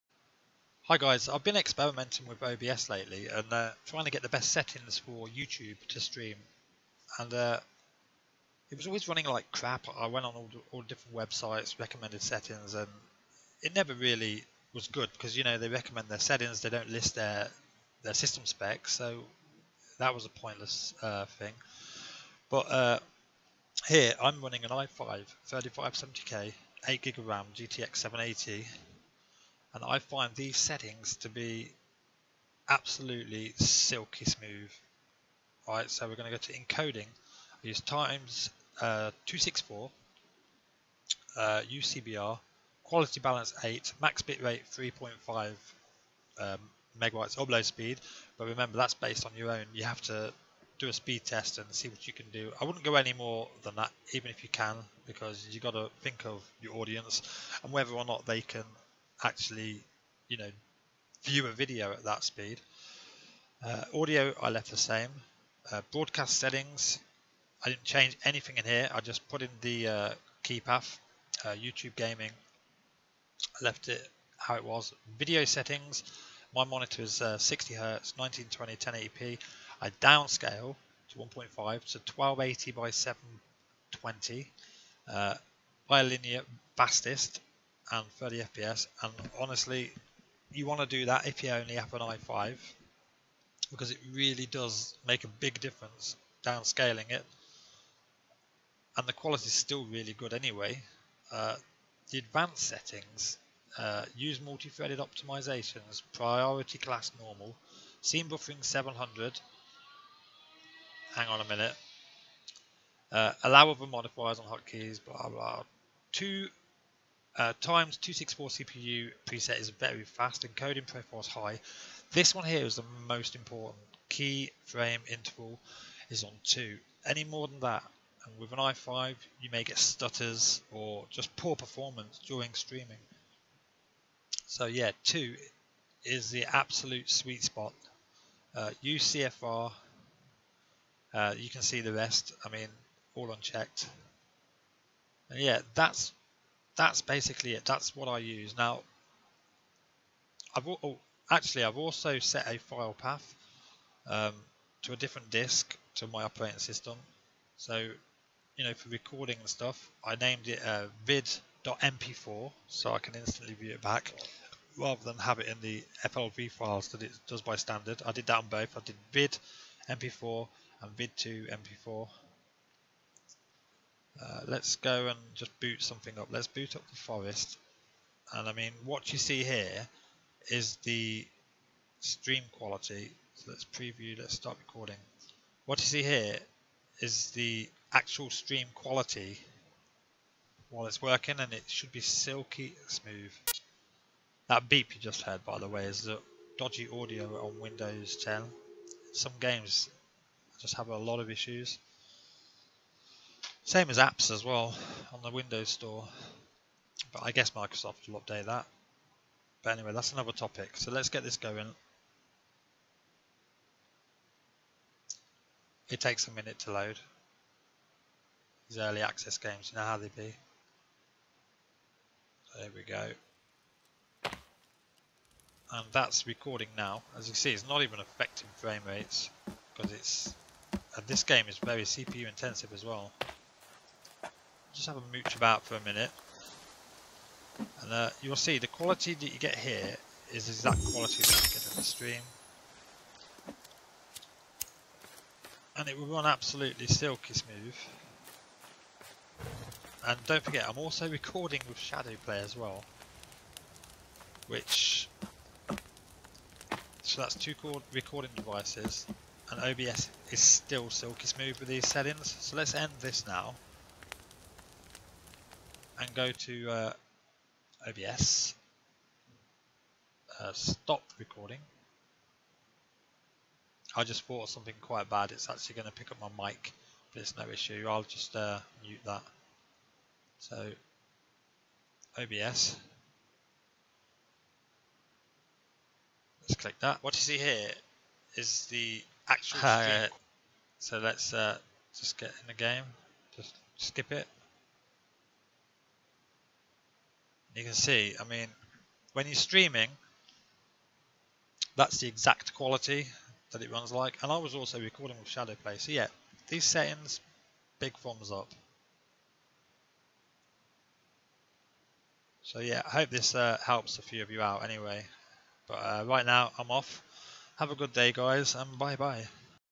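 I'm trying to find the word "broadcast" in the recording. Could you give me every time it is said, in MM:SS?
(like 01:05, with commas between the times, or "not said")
01:05.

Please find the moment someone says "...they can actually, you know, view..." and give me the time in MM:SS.
00:58.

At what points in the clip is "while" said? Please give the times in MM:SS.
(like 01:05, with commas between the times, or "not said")
03:10.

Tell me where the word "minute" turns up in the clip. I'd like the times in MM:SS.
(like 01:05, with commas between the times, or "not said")
01:51, 03:36, 03:55.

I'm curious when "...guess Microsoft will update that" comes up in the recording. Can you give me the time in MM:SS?
03:27.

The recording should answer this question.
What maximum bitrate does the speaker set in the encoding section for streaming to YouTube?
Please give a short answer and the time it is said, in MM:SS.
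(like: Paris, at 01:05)
3.5, at 00:44.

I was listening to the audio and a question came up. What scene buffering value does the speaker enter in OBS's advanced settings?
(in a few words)
700.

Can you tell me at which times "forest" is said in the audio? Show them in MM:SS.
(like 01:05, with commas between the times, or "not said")
02:56.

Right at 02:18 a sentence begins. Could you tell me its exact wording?
Uh, use CFR, uh, you can see the rest, I mean, all unchecked.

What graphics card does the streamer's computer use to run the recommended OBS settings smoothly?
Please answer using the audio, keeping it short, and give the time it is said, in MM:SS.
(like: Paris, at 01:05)
GTX 780, at 00:27.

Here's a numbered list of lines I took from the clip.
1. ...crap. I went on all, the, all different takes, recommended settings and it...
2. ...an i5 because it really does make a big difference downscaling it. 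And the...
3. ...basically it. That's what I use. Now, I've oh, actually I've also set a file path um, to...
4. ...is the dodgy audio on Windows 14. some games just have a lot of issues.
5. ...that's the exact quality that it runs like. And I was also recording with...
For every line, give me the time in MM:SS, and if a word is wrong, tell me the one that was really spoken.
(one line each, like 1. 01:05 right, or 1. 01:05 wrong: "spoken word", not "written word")
1. 00:09 wrong: "websites", not "takes"
2. 01:31 right
3. 02:27 right
4. 03:15 wrong: "10", not "14"
5. 05:01 right.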